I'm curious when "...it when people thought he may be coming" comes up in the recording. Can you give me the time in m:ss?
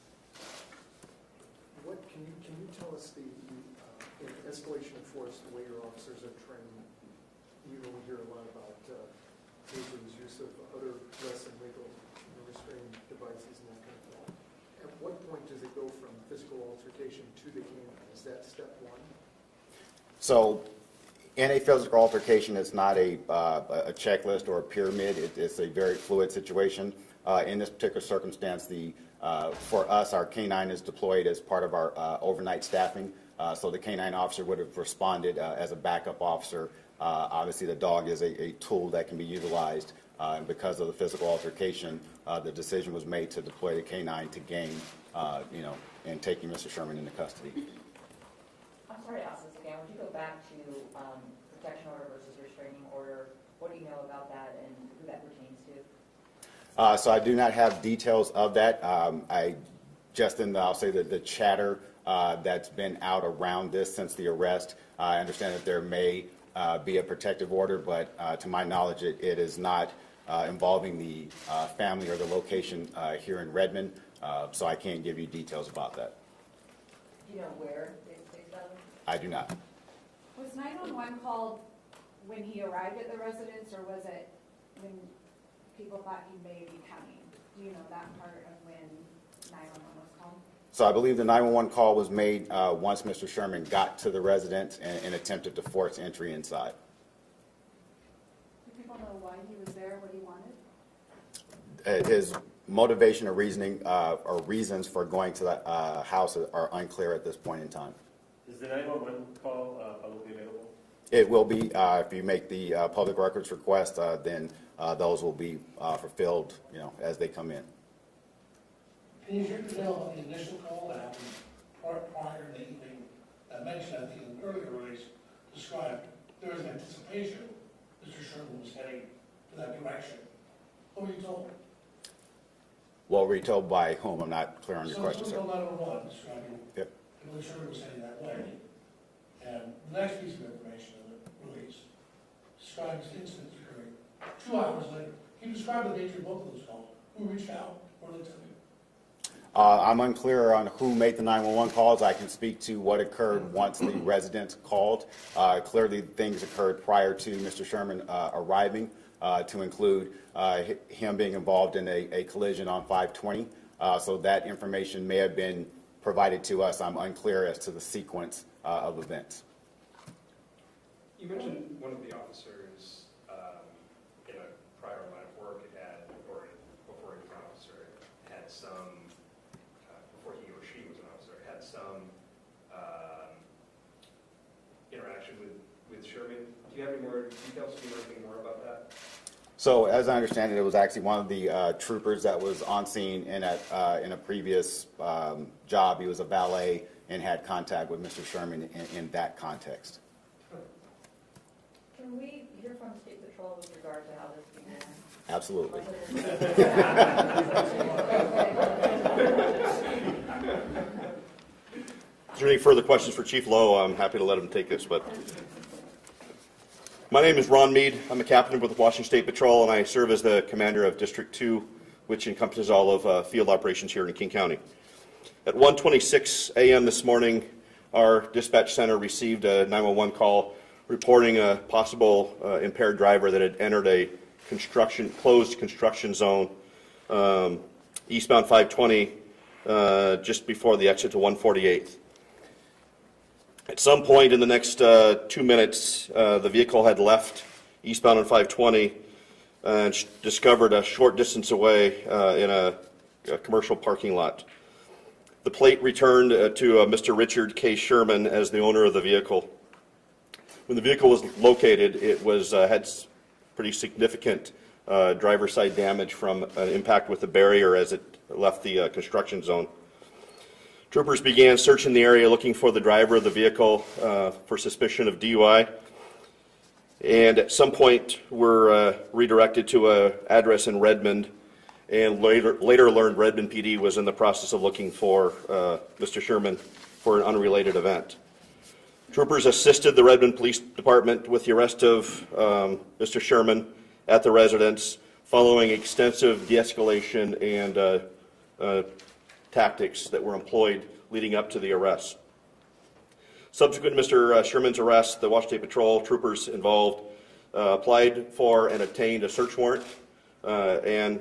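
1:24.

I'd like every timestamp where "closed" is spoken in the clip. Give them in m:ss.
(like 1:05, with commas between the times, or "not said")
3:55.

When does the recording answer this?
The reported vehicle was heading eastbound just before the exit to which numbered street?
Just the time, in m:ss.
4:01.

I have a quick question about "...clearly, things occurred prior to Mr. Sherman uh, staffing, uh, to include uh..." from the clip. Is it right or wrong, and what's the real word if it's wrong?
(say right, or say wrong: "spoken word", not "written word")
wrong: "arriving", not "staffing".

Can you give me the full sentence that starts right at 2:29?
Uh, I'm unclear on who made the 911 calls.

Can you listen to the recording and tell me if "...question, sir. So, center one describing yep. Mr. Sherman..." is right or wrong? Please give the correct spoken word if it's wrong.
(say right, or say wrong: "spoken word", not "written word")
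wrong: "letter", not "center".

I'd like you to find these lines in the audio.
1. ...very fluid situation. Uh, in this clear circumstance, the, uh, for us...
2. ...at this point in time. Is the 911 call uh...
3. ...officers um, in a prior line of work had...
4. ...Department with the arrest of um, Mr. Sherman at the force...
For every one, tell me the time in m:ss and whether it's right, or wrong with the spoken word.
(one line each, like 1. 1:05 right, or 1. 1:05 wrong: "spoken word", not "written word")
1. 0:25 wrong: "particular", not "clear"
2. 1:47 right
3. 2:52 right
4. 4:50 wrong: "residence", not "force".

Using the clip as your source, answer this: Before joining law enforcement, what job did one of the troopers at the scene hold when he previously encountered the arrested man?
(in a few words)
valet.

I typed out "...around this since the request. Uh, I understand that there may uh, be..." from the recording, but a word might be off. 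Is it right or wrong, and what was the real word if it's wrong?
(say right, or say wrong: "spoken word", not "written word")
wrong: "arrest", not "request".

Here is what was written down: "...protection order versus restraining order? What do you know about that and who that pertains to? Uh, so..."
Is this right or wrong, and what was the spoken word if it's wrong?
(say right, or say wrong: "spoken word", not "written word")
right.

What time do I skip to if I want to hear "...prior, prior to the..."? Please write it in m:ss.
2:01.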